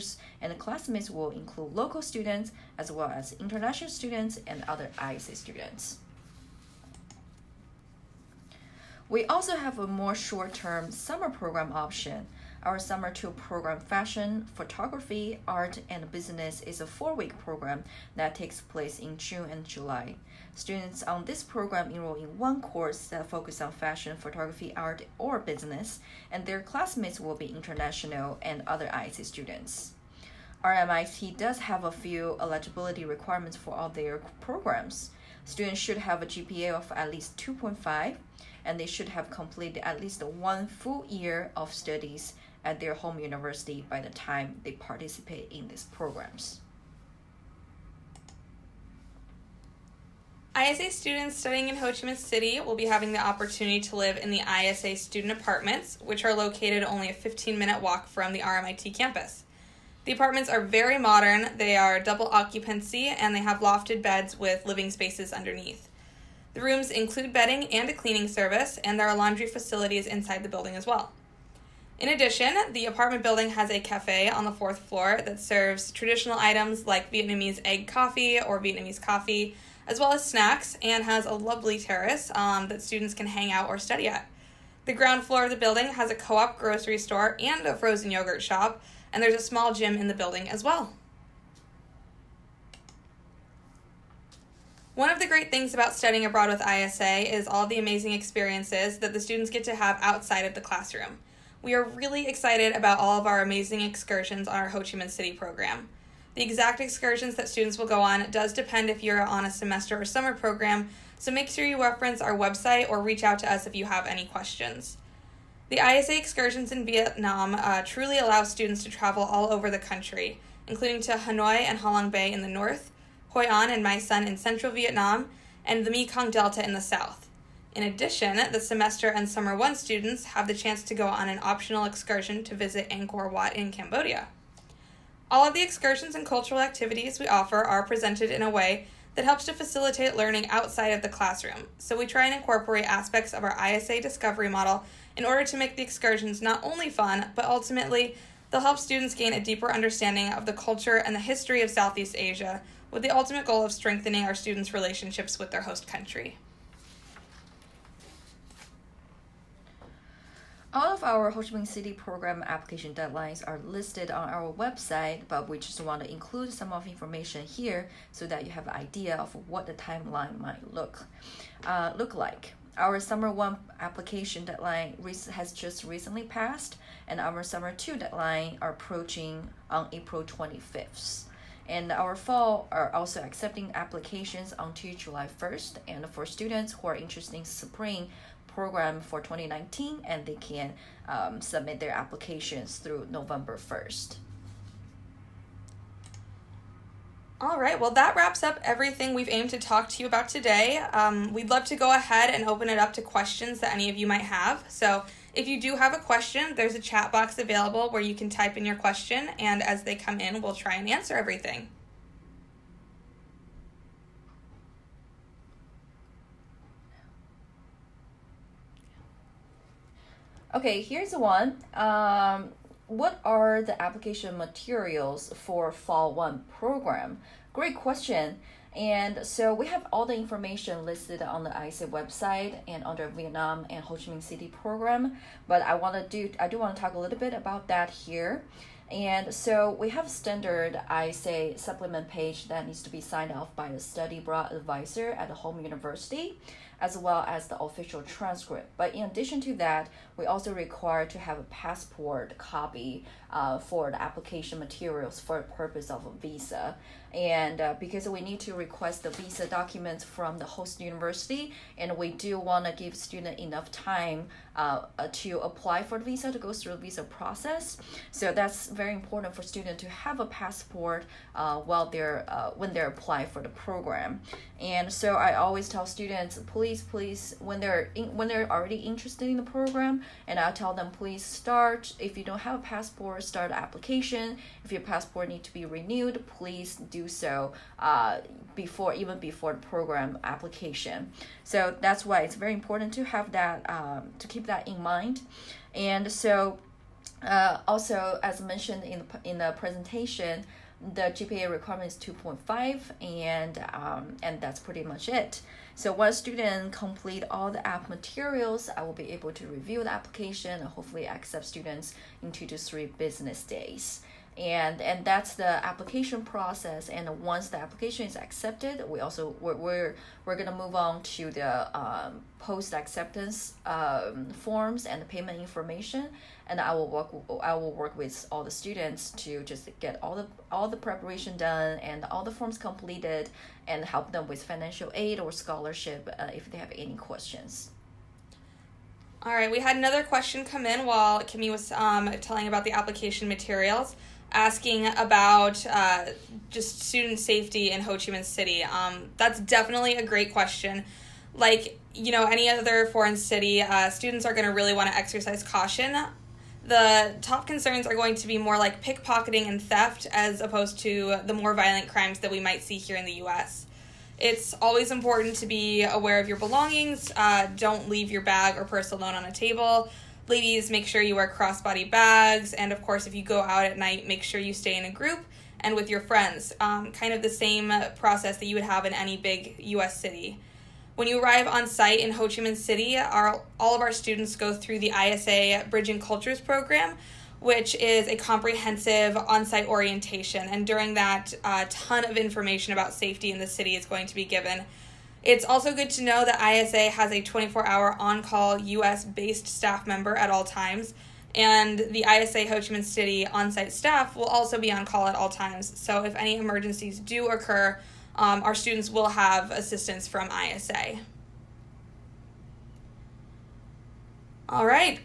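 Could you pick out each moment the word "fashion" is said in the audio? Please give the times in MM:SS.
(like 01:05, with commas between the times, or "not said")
00:13, 00:23.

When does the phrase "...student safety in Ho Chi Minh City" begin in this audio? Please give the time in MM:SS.
05:46.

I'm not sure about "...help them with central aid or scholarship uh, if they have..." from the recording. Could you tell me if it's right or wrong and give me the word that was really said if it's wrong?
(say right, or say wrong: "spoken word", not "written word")
wrong: "financial", not "central".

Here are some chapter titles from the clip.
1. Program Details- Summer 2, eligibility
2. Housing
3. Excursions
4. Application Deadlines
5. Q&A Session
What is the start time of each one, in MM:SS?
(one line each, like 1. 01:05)
1. 00:07
2. 00:48
3. 01:33
4. 02:38
5. 03:16.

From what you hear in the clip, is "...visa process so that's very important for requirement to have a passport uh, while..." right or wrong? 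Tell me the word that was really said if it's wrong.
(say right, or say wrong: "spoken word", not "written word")
wrong: "student", not "requirement".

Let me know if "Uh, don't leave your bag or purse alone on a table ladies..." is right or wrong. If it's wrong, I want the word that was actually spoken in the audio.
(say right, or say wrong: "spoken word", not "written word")
right.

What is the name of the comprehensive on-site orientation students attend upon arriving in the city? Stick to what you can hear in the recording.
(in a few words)
Bridging Cultures.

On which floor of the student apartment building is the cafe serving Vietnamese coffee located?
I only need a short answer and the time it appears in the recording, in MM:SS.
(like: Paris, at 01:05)
fourth floor, at 01:14.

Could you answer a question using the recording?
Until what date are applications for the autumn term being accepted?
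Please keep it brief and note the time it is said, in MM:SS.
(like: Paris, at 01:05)
July 1st, at 03:04.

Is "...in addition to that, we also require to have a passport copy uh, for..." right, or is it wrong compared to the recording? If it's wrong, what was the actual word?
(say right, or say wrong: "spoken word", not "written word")
right.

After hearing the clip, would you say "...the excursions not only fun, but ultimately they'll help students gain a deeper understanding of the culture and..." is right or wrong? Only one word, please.
right.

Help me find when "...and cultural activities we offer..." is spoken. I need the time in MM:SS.
02:16.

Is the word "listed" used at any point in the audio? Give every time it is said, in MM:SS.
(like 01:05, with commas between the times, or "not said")
02:43, 03:50.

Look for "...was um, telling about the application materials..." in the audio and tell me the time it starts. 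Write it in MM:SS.
05:41.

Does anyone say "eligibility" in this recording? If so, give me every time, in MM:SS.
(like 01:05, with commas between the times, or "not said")
00:32.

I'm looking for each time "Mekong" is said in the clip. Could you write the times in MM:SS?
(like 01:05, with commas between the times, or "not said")
02:05.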